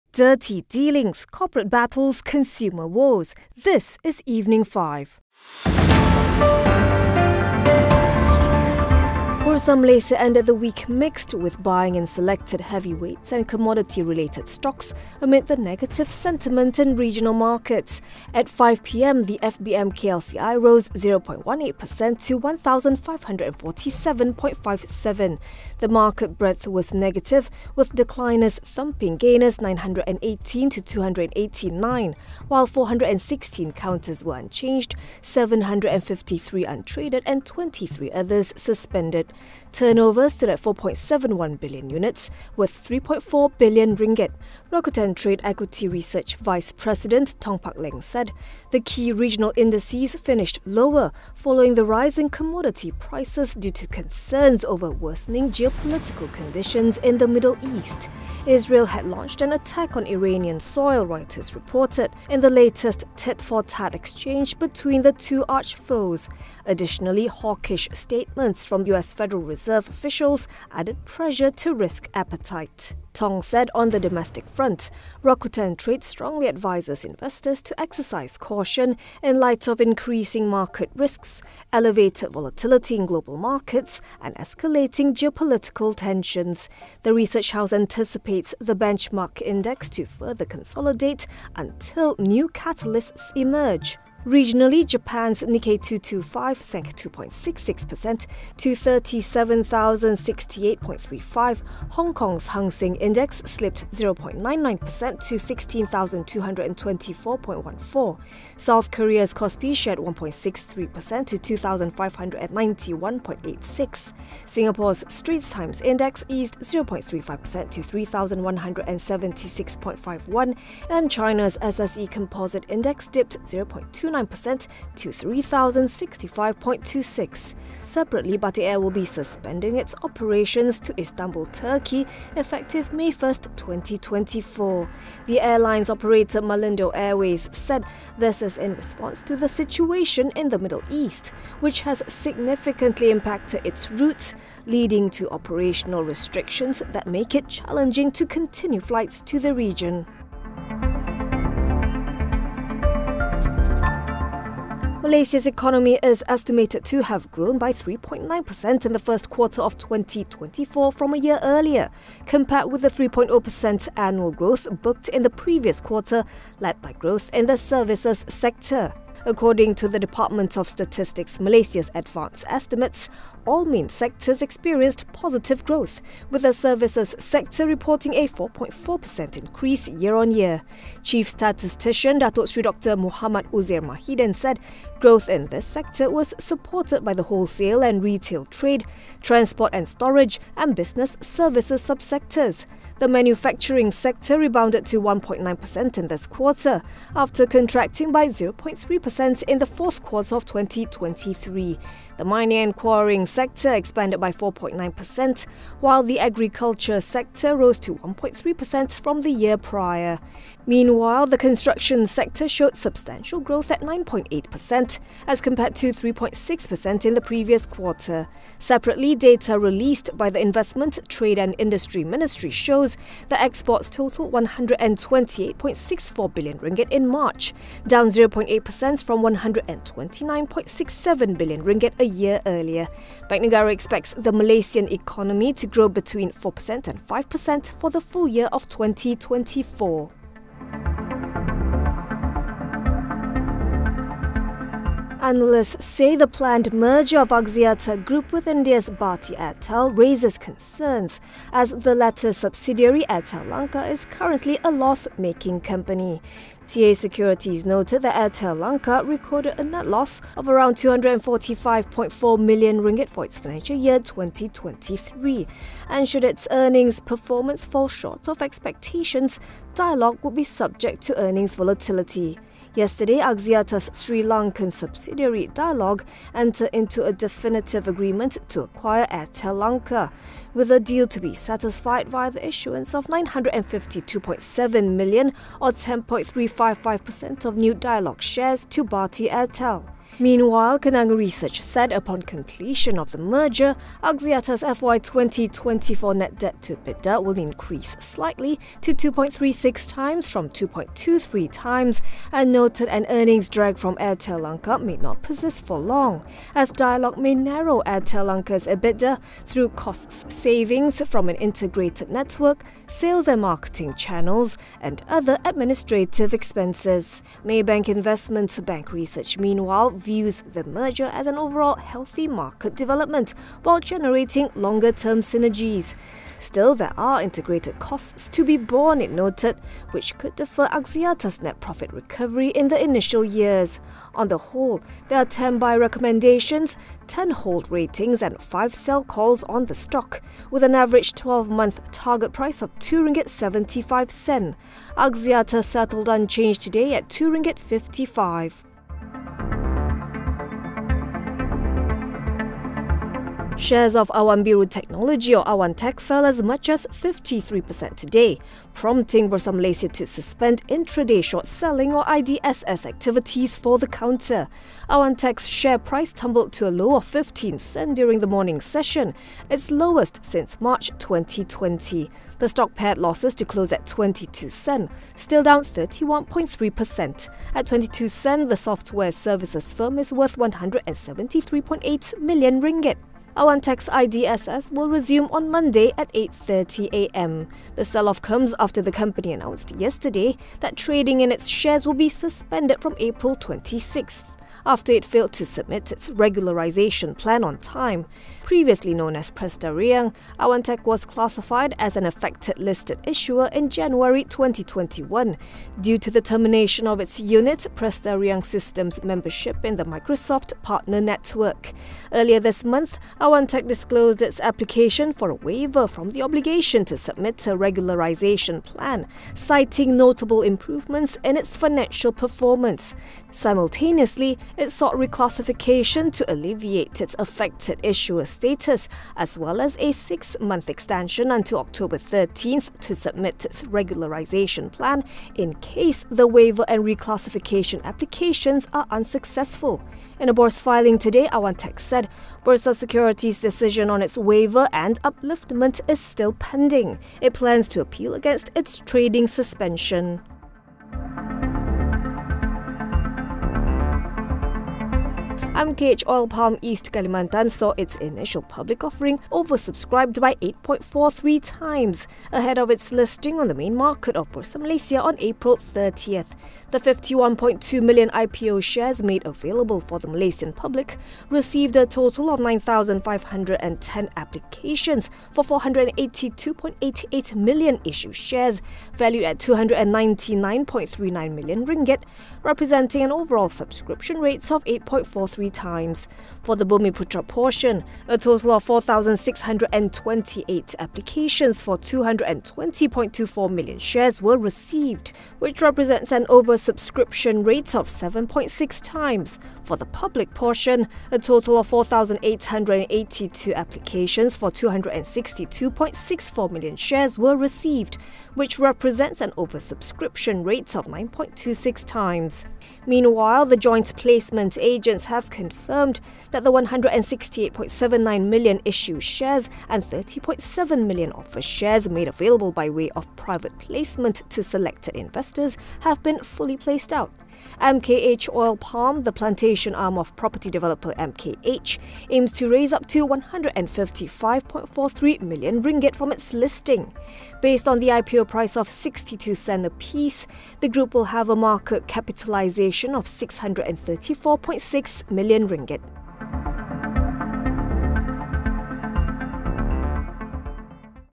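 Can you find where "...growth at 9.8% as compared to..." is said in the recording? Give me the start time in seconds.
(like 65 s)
213 s.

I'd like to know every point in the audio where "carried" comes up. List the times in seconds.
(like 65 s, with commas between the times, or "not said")
not said.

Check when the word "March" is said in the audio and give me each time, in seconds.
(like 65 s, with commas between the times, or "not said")
227 s, 370 s.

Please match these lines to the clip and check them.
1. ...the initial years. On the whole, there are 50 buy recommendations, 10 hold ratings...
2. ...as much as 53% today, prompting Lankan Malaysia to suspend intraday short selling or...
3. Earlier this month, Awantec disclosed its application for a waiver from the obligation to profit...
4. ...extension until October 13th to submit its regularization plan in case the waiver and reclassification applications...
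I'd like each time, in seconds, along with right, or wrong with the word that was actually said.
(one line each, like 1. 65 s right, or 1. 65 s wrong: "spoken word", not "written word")
1. 332 s wrong: "10", not "50"
2. 356 s wrong: "Bursa", not "Lankan"
3. 412 s wrong: "submit", not "profit"
4. 430 s right.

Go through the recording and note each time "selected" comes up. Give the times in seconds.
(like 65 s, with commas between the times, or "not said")
12 s, 524 s.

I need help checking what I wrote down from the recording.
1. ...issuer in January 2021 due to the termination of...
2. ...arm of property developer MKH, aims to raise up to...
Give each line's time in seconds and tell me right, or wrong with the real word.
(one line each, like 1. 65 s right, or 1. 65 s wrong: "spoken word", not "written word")
1. 403 s right
2. 529 s right.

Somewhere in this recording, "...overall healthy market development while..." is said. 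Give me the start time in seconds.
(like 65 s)
321 s.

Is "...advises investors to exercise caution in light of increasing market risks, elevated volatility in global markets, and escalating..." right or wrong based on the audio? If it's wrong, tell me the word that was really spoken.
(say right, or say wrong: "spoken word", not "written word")
right.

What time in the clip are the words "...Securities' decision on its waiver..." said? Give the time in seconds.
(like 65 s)
442 s.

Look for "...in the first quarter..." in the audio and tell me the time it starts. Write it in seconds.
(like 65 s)
158 s.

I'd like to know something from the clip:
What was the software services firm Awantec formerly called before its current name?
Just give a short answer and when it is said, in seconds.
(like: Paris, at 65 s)
Presta Riang, at 399 s.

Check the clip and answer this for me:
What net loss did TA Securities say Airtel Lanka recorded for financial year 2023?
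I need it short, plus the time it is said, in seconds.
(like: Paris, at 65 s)
245.4 million ringgit, at 260 s.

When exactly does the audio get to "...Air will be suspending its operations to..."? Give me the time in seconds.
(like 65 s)
128 s.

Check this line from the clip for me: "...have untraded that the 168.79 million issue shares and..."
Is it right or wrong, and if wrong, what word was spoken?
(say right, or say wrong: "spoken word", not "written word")
wrong: "confirmed", not "untraded".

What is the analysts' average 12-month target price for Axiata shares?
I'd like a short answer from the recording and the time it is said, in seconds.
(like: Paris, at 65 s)
2 ringgit 75 sen, at 342 s.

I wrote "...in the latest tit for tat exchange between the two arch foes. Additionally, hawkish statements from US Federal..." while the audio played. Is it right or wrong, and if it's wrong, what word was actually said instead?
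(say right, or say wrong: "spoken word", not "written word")
right.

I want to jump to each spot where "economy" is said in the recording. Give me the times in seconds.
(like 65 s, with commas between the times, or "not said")
155 s, 234 s.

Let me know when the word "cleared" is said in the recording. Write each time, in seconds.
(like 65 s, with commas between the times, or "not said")
not said.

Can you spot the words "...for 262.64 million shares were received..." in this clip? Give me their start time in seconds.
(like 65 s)
504 s.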